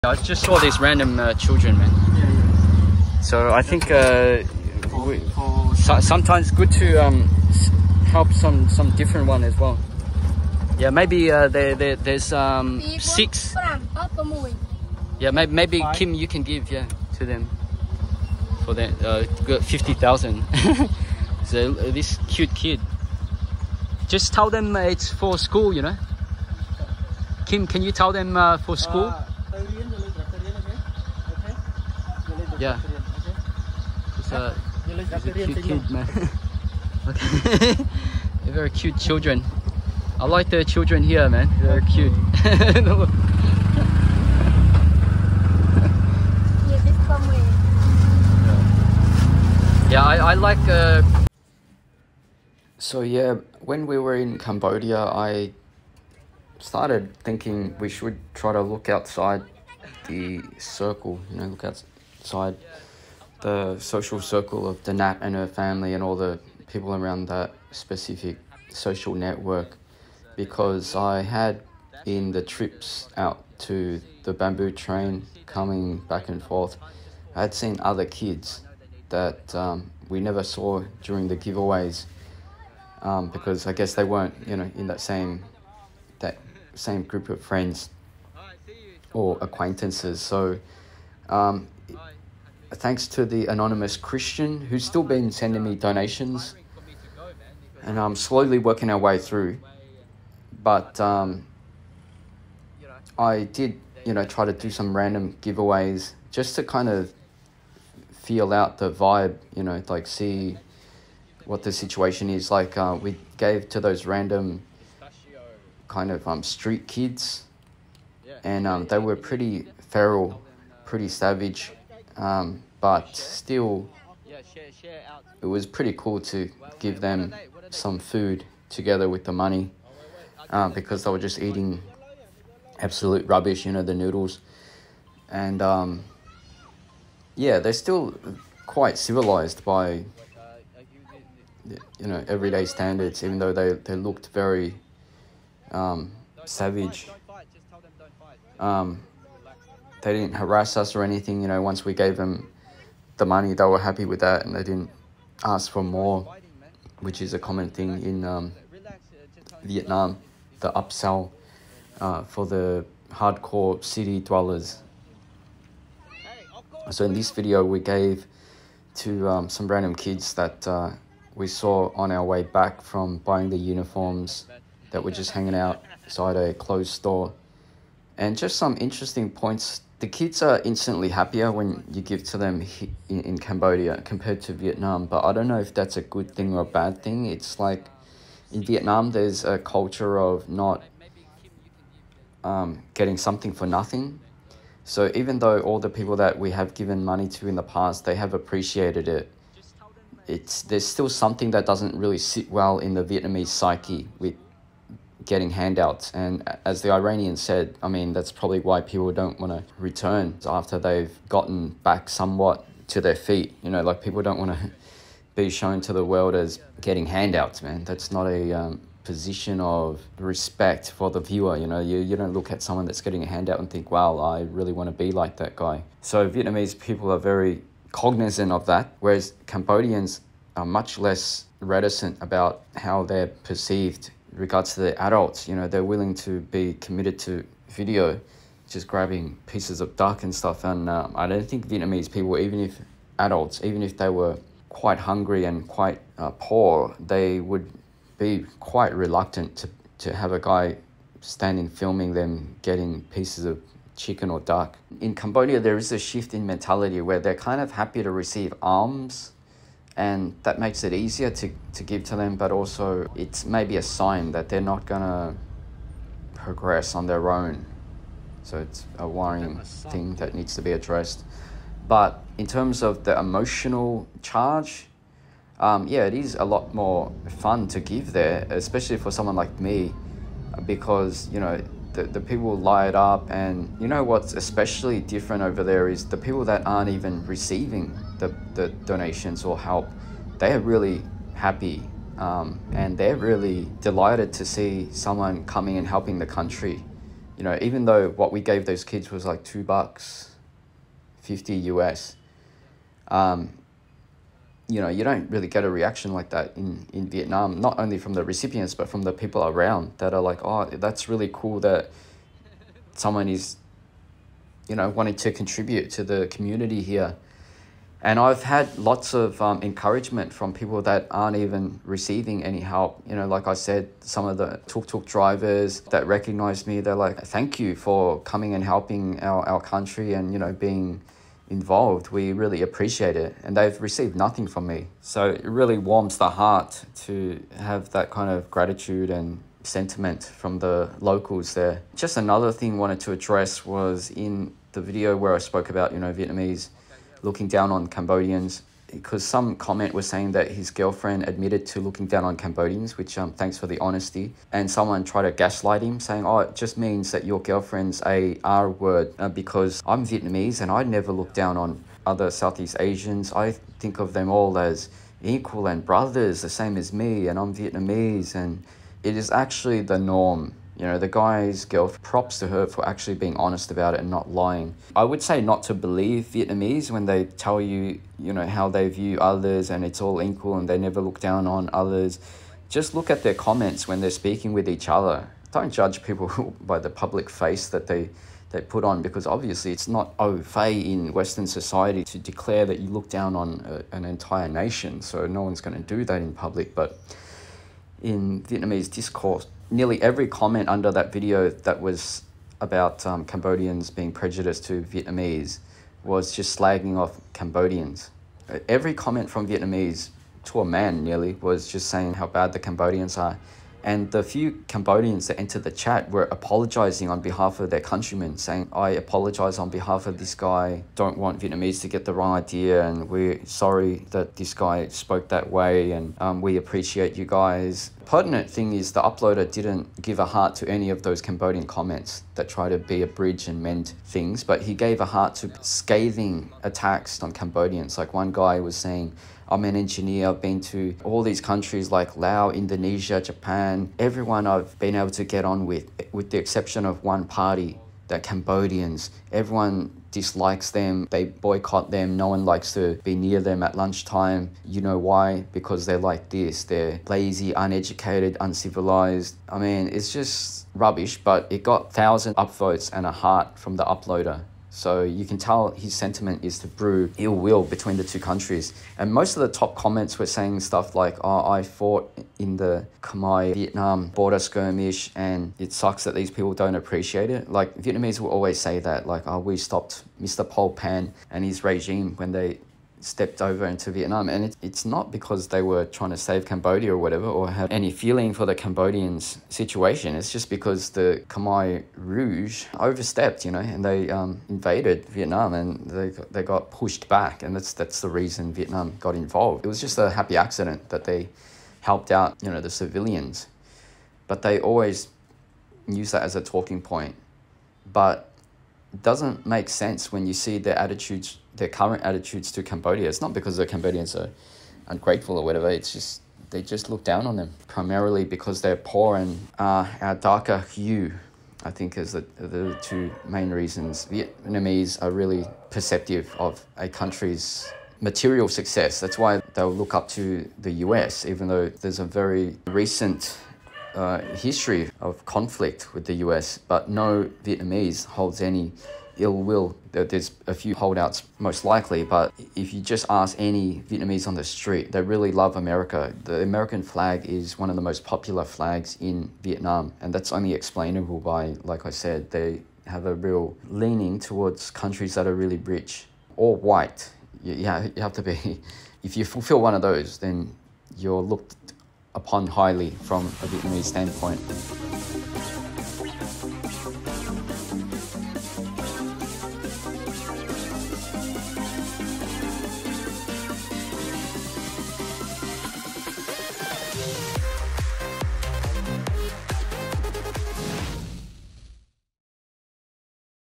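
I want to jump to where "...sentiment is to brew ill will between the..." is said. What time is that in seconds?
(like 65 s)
465 s.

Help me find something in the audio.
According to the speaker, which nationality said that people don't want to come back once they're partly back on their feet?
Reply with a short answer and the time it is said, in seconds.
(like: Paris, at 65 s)
Iranians, at 206 s.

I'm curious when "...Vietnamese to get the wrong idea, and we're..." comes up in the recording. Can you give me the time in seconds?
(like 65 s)
421 s.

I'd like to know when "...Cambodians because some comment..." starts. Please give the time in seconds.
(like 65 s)
347 s.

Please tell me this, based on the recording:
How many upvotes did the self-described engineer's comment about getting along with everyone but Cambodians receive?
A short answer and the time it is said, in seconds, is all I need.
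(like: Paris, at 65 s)
1,000, at 461 s.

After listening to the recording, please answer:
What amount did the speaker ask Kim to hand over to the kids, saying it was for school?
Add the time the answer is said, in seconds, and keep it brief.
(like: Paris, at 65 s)
50,000, at 19 s.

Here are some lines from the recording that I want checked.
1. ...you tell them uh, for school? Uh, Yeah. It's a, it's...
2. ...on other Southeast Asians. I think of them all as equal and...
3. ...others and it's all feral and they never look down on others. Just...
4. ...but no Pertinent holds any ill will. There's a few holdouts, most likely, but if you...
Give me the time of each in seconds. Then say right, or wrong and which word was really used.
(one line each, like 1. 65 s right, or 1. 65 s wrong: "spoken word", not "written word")
1. 27 s right
2. 361 s right
3. 379 s wrong: "equal", not "feral"
4. 536 s wrong: "Vietnamese", not "Pertinent".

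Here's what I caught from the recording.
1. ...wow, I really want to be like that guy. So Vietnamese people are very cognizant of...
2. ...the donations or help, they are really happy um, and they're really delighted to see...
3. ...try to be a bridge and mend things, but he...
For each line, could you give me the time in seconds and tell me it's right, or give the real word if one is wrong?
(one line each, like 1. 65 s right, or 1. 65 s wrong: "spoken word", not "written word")
1. 223 s right
2. 288 s right
3. 432 s right.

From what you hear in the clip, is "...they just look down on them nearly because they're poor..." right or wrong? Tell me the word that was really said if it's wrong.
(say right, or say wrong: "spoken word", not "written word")
wrong: "primarily", not "nearly".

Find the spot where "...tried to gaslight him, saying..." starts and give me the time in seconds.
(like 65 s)
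355 s.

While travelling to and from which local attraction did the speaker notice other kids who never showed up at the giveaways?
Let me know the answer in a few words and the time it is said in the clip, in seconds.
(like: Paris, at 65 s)
the bamboo train, at 74 s.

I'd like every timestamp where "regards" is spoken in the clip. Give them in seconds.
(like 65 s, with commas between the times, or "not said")
234 s.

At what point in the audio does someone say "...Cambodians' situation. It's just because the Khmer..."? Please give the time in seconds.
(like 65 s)
488 s.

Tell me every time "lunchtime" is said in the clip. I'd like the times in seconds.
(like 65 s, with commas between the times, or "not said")
453 s.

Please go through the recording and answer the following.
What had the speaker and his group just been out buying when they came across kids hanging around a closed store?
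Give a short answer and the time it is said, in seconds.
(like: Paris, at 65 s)
uniforms, at 173 s.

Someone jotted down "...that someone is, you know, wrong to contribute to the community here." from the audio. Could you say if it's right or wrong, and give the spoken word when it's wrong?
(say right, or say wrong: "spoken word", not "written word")
wrong: "wanting", not "wrong".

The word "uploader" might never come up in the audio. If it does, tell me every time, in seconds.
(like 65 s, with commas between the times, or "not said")
429 s, 463 s.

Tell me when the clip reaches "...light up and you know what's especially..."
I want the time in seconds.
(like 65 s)
282 s.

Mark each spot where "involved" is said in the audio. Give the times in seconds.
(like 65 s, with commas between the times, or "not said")
331 s, 499 s.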